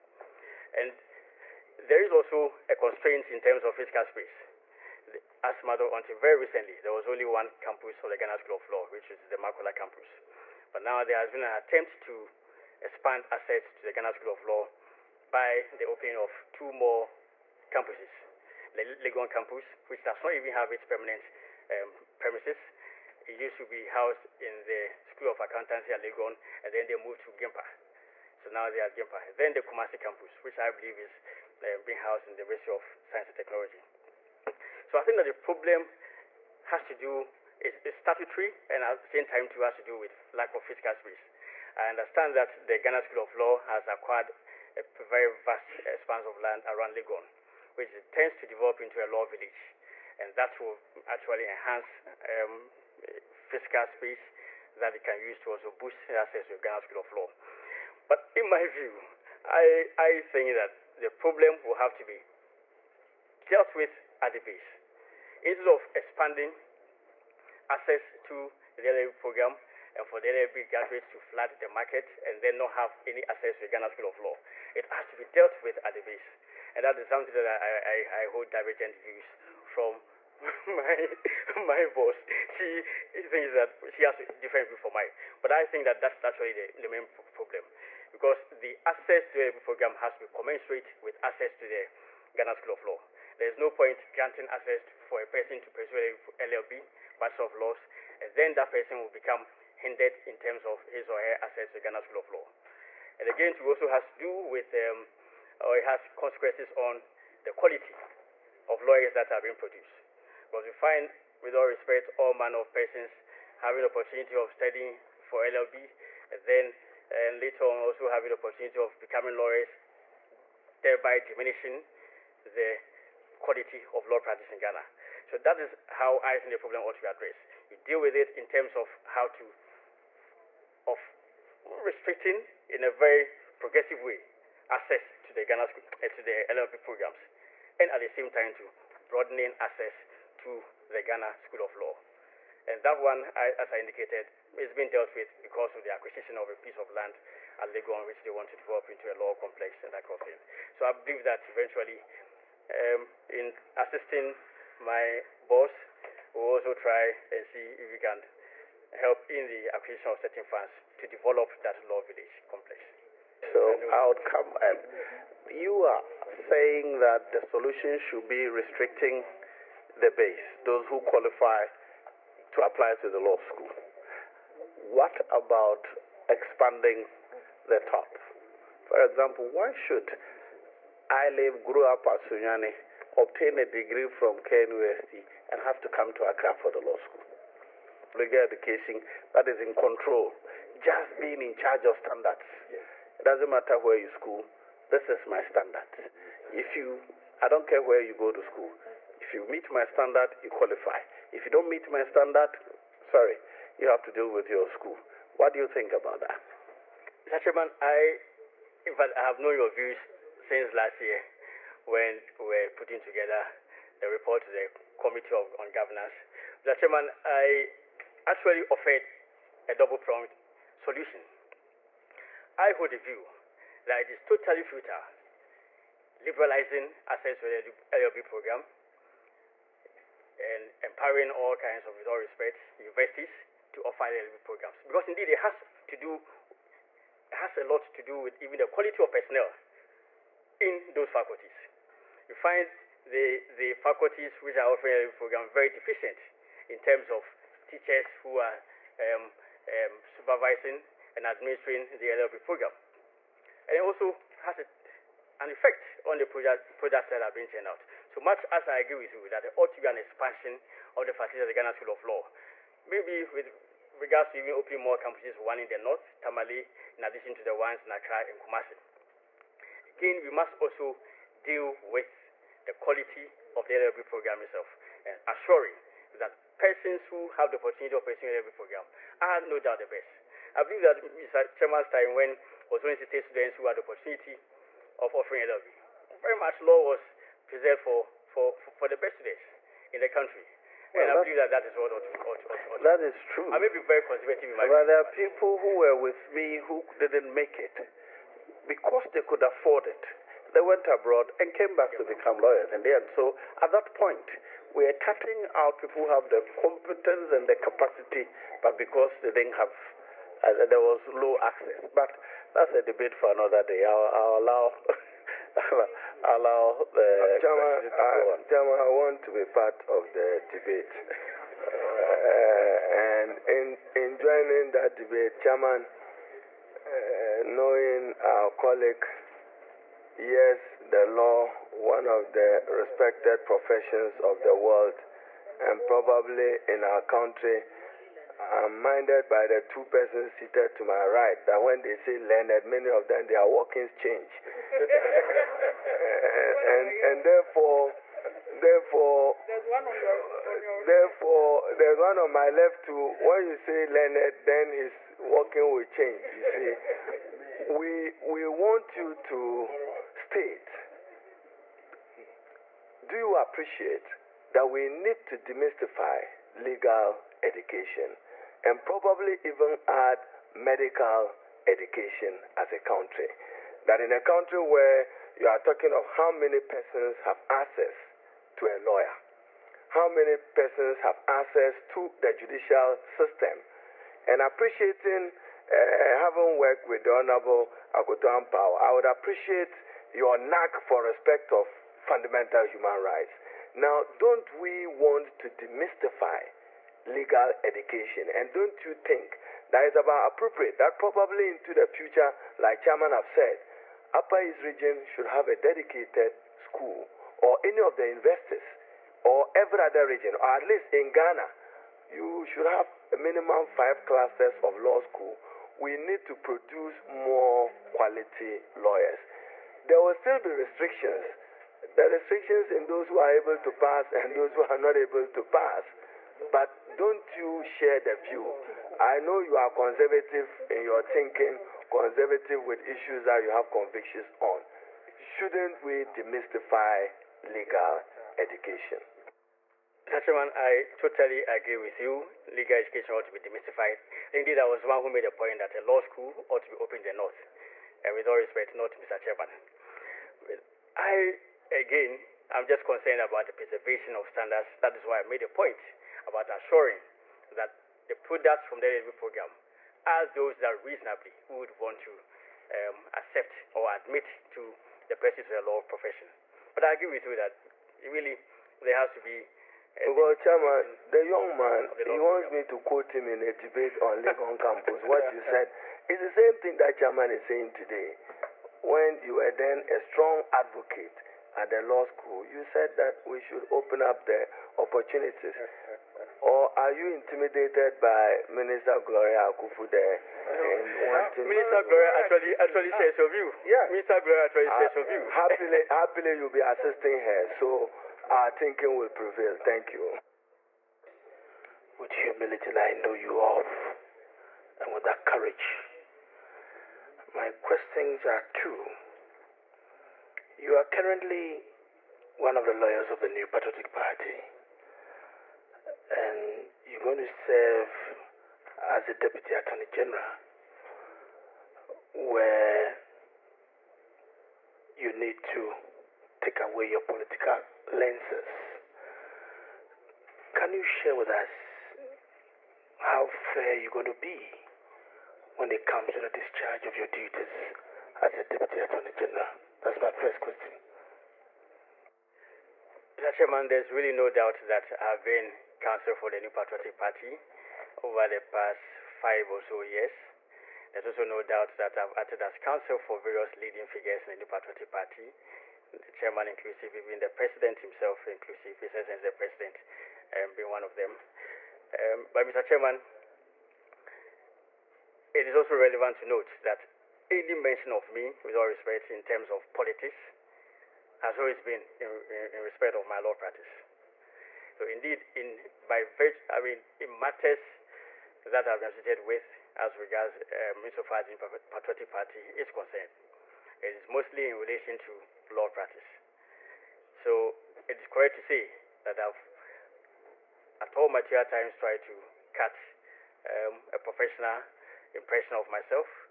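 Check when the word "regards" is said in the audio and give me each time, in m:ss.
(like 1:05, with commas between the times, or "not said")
4:23, 9:39.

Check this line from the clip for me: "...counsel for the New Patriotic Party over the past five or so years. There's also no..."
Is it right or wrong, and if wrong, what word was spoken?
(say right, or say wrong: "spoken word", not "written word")
right.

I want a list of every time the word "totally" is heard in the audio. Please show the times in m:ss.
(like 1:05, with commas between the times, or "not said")
3:44, 7:20.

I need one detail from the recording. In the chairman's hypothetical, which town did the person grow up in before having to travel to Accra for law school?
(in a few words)
Sunyani.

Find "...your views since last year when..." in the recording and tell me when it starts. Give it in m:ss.
3:29.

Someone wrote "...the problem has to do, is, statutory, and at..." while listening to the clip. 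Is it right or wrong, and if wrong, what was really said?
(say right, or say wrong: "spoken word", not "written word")
right.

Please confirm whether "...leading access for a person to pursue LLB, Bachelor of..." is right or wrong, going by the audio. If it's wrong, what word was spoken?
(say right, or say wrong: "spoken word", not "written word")
wrong: "granting", not "leading".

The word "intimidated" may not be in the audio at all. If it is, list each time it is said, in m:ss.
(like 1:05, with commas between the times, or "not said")
8:07.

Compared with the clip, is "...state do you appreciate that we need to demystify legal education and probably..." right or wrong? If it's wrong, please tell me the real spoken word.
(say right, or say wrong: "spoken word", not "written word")
right.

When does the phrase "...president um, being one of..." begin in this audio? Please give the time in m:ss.
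9:19.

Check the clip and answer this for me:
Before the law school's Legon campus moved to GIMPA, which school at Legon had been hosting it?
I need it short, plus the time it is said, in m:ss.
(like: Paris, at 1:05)
School of Accountancy, at 0:25.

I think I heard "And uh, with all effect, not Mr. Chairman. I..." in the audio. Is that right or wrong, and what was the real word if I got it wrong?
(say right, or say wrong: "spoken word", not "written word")
wrong: "respect", not "effect".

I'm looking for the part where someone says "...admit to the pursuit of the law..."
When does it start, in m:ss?
7:43.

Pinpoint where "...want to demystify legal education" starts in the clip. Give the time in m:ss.
6:34.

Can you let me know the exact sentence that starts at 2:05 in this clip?
So that is how I think the problem ought to be addressed.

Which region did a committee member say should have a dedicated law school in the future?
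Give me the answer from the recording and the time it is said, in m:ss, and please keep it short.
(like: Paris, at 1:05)
Upper East, at 6:44.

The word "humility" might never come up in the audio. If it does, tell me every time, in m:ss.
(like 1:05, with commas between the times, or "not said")
8:22.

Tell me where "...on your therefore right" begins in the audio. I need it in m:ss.
5:50.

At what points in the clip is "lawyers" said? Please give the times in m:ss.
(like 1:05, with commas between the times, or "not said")
1:48, 1:59, 5:02, 6:18, 6:58, 8:32.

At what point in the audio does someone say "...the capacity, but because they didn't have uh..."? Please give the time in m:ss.
5:07.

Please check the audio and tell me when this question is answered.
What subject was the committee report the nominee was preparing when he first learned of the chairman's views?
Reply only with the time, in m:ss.
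3:35.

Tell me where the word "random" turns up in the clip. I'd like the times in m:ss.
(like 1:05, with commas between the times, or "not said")
not said.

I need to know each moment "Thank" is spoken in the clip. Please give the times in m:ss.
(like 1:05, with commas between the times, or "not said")
8:19.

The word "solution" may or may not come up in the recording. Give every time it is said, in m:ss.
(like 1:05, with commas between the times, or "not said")
2:47, 3:40.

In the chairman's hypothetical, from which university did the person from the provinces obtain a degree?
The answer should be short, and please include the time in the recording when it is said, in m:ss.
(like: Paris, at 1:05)
KNUST, at 3:04.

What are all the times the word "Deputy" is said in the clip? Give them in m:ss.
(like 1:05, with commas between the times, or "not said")
8:39, 8:58.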